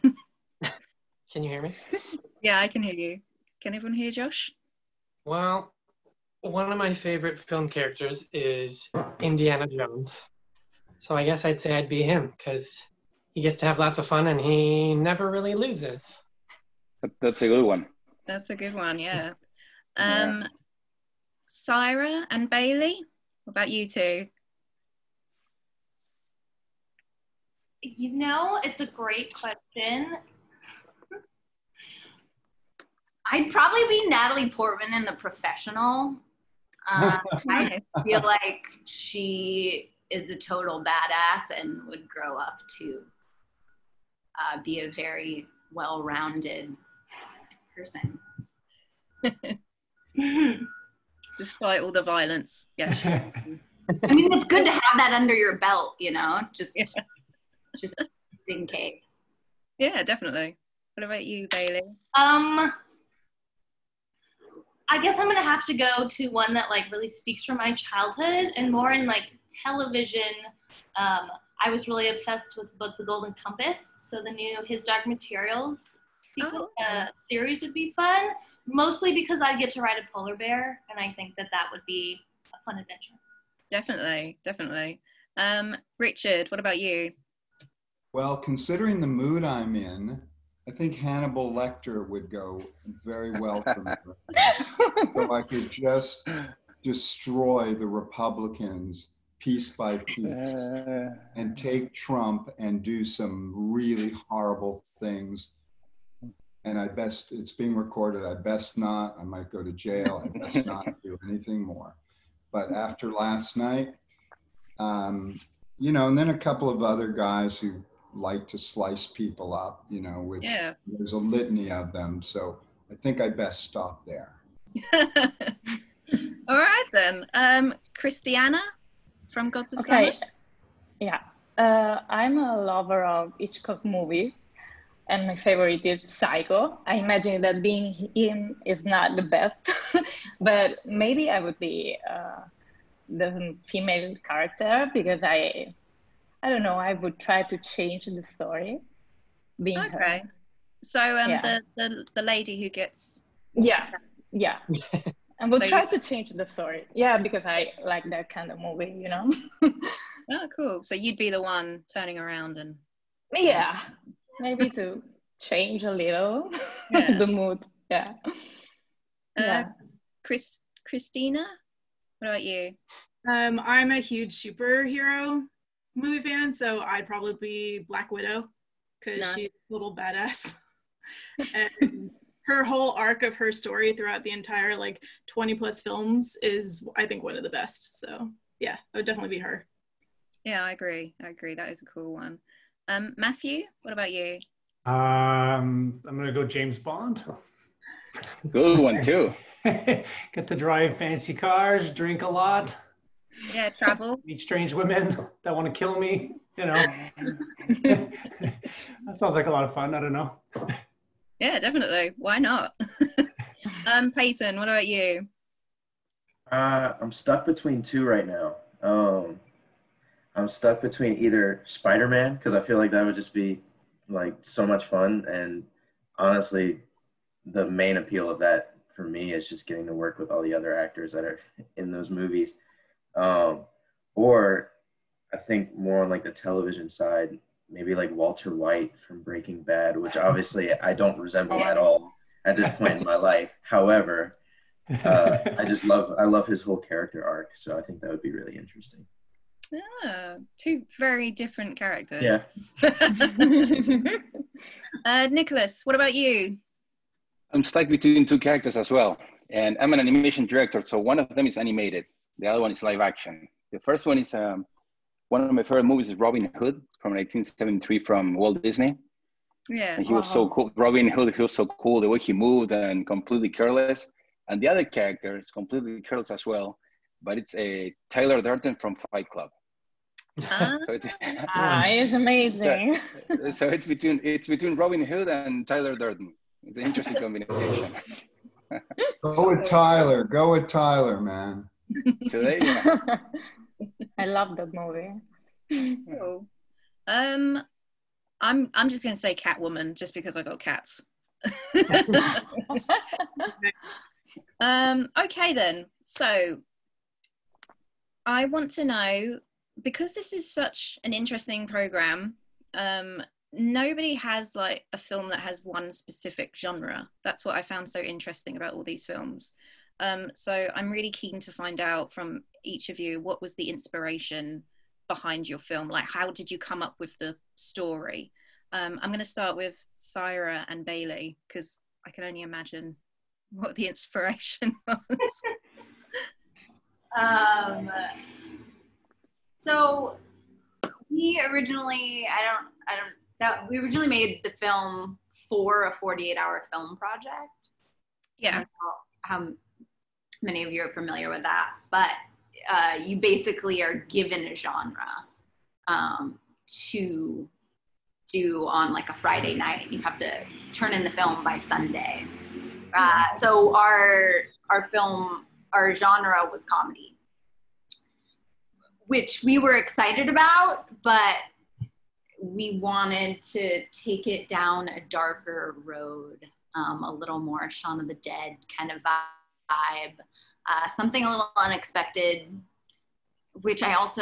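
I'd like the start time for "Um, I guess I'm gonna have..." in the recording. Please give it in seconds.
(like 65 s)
62 s.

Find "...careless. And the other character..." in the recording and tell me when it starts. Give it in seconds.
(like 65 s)
273 s.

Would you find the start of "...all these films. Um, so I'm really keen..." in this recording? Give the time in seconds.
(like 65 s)
318 s.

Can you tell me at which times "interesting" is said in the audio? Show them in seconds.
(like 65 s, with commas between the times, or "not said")
248 s, 286 s, 311 s, 318 s.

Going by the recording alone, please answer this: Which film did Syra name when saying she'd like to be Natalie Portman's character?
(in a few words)
The Professional.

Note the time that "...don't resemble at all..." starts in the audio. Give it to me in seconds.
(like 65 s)
240 s.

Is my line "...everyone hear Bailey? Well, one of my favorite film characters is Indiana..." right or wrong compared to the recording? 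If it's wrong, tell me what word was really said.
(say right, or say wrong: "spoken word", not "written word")
wrong: "Josh", not "Bailey".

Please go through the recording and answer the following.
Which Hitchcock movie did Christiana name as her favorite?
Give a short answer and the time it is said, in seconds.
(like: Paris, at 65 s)
Psycho, at 136 s.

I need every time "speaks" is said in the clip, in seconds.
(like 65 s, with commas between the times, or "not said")
67 s.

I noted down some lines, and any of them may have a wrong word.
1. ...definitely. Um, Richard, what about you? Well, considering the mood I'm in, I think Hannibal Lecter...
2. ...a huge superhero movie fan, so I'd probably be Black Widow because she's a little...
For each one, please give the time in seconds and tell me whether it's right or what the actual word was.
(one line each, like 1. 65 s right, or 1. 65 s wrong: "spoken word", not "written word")
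1. 84 s right
2. 173 s right.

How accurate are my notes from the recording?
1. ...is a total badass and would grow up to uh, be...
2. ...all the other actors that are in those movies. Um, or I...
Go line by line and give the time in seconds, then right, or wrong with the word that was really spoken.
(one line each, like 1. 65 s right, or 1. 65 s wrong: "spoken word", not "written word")
1. 40 s right
2. 230 s right.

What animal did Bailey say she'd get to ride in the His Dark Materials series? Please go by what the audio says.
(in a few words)
polar bear.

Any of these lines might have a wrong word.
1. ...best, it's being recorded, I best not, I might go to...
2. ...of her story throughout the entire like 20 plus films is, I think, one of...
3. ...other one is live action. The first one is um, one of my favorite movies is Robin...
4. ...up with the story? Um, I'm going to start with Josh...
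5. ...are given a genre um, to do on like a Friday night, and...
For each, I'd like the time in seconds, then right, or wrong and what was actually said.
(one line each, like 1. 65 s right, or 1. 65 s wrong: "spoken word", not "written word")
1. 106 s right
2. 183 s right
3. 262 s right
4. 326 s wrong: "Syra", not "Josh"
5. 353 s right.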